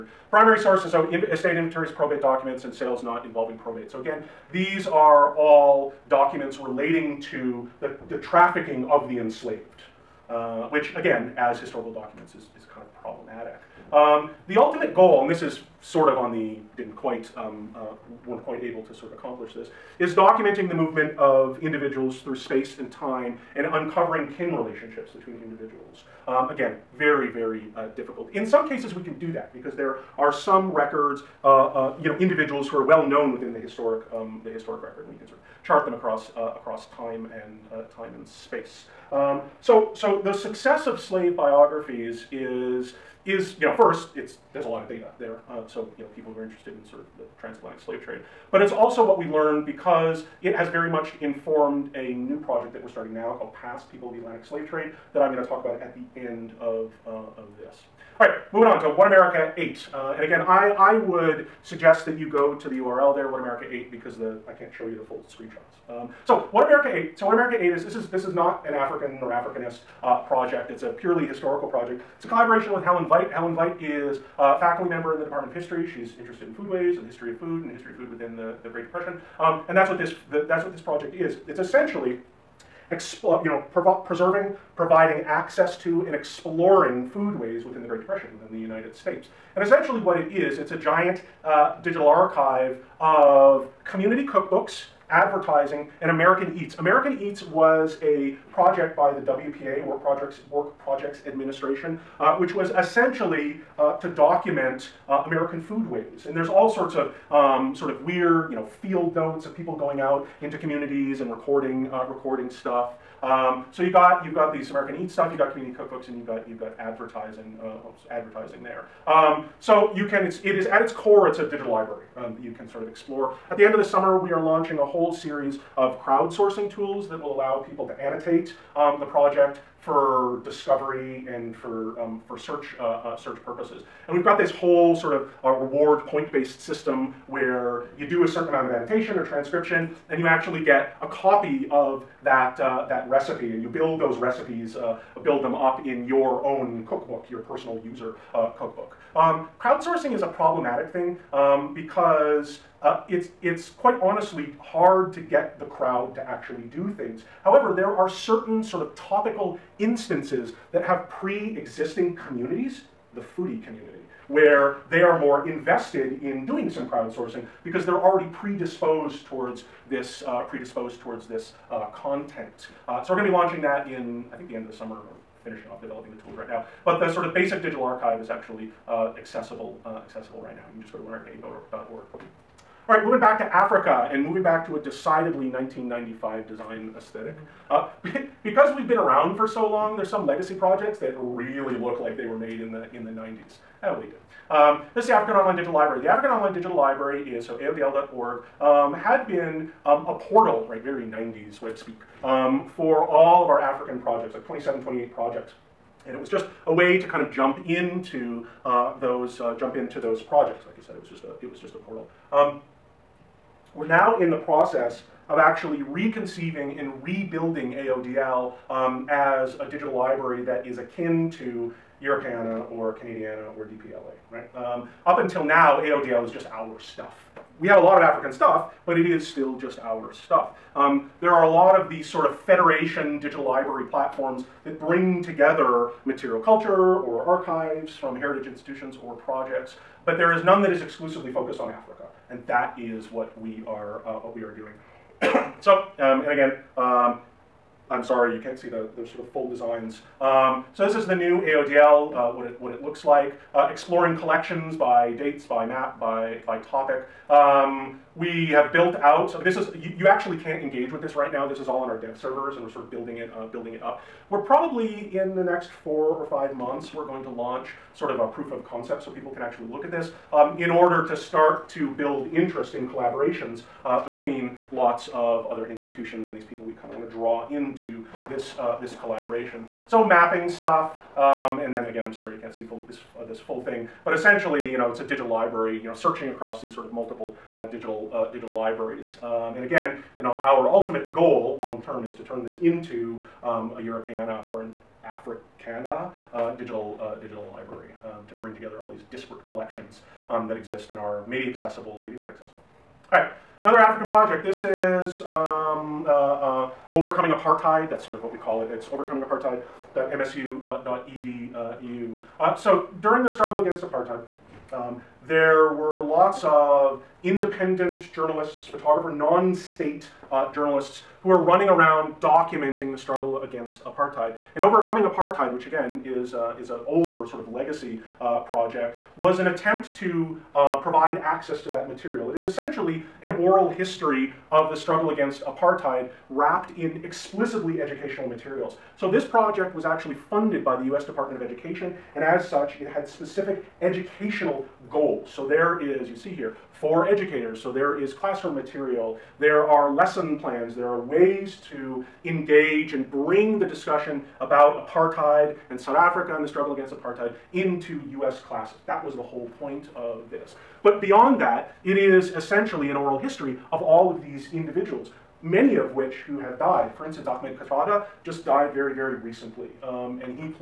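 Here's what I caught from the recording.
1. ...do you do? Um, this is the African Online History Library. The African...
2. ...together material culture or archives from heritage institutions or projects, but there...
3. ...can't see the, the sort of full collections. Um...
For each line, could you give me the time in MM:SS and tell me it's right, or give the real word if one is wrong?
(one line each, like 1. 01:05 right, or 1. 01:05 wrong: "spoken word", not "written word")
1. 03:14 wrong: "Digital", not "History"
2. 03:55 right
3. 04:08 wrong: "designs", not "collections".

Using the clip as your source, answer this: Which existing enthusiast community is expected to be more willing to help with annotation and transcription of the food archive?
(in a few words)
the foodie community.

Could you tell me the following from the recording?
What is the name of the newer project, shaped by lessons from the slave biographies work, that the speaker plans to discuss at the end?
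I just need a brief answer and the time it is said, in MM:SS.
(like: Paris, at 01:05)
Past People of the Atlantic Slave Trade, at 00:53.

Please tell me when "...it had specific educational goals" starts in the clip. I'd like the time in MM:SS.
05:42.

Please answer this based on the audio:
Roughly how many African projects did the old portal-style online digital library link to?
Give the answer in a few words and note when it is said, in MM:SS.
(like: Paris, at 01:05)
27 or 28, at 03:24.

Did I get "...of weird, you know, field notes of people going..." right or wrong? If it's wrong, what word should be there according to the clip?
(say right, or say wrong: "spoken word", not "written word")
right.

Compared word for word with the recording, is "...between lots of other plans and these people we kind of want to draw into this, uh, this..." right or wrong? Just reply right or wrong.
wrong.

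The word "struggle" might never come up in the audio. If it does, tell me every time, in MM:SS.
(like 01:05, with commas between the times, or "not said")
05:13, 05:22, 05:34, 05:56.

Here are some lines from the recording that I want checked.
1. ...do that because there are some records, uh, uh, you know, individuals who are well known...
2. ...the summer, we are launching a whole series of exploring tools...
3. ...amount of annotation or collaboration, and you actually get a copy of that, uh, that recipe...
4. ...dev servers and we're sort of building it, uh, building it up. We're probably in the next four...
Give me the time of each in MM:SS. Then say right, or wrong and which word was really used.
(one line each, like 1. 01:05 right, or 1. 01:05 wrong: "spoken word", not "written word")
1. 00:29 right
2. 02:03 wrong: "crowdsourcing", not "exploring"
3. 02:18 wrong: "transcription", not "collaboration"
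4. 04:21 right.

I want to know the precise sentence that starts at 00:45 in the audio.
Uh, so, you know, people who are interested in sort of the transatlantic slave trade.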